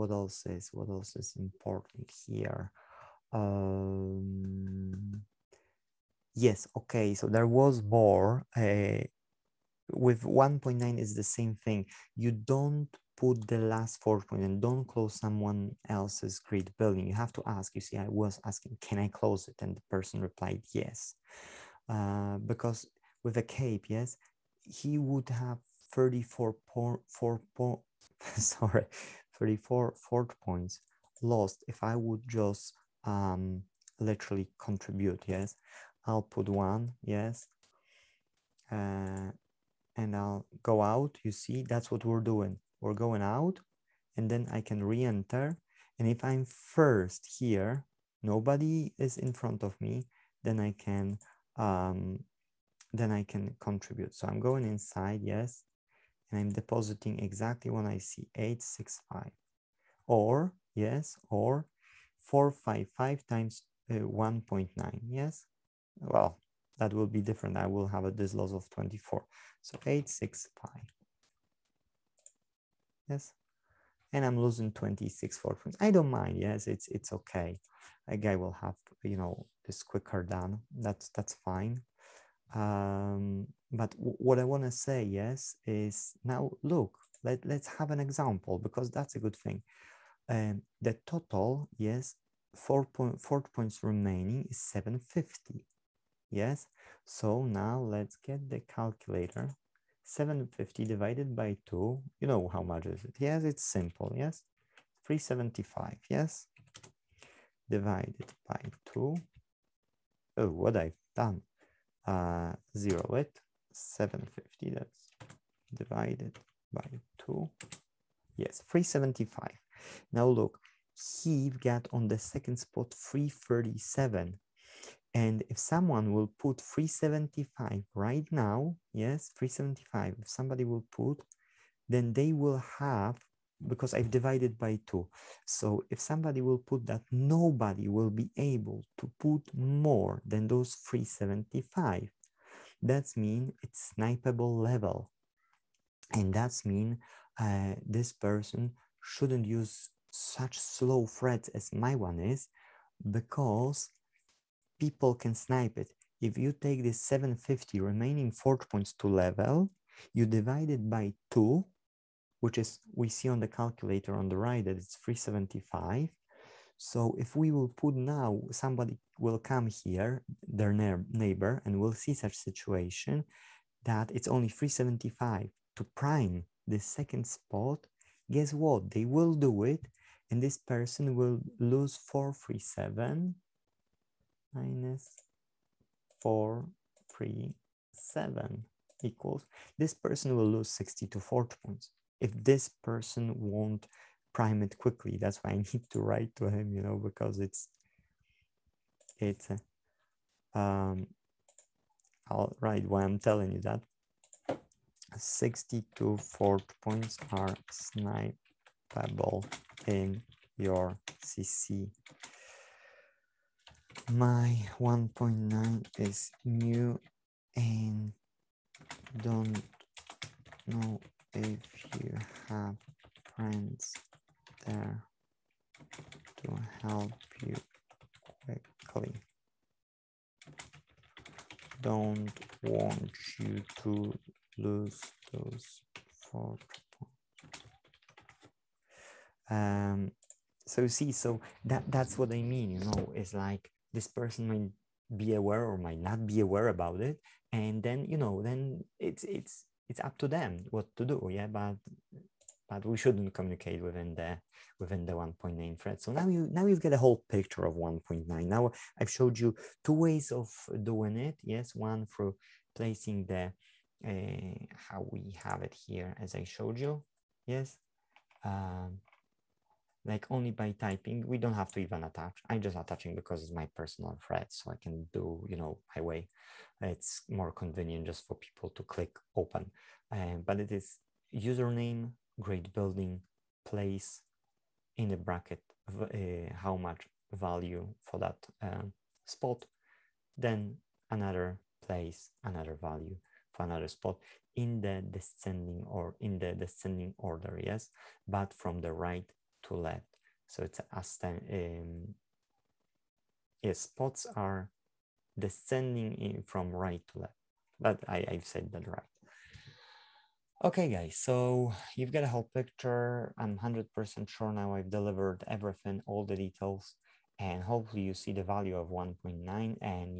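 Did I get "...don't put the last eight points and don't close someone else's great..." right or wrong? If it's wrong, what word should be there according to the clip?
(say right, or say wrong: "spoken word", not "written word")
wrong: "four", not "eight".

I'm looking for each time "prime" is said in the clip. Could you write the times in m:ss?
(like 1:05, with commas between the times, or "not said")
2:55, 3:14.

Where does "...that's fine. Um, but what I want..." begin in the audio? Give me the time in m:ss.
1:21.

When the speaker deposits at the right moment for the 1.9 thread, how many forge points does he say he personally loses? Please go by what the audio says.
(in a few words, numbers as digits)
26.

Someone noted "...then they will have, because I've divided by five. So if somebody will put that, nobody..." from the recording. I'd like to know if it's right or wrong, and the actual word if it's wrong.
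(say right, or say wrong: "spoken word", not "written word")
wrong: "two", not "five".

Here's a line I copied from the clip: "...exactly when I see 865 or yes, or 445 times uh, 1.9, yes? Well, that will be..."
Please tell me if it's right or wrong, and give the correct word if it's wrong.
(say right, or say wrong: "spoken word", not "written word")
wrong: "455", not "445".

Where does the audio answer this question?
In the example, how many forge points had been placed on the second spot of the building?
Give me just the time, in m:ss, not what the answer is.
2:02.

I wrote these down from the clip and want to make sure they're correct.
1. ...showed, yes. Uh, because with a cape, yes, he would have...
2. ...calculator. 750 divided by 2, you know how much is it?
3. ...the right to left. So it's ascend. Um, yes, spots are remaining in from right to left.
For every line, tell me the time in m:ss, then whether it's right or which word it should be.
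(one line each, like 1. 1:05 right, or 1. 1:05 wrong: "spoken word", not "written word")
1. 0:20 wrong: "replied", not "showed"
2. 1:38 right
3. 4:58 wrong: "descending", not "remaining".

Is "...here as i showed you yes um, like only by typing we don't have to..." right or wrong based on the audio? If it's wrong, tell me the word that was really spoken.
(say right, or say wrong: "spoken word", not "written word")
right.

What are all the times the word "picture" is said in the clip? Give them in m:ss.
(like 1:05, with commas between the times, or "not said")
4:17, 5:12.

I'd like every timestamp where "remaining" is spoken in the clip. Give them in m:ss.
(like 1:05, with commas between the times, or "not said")
1:33, 2:37.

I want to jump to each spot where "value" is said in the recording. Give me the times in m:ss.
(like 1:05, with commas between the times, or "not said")
4:47, 4:52, 5:18.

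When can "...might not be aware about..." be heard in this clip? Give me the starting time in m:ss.
4:05.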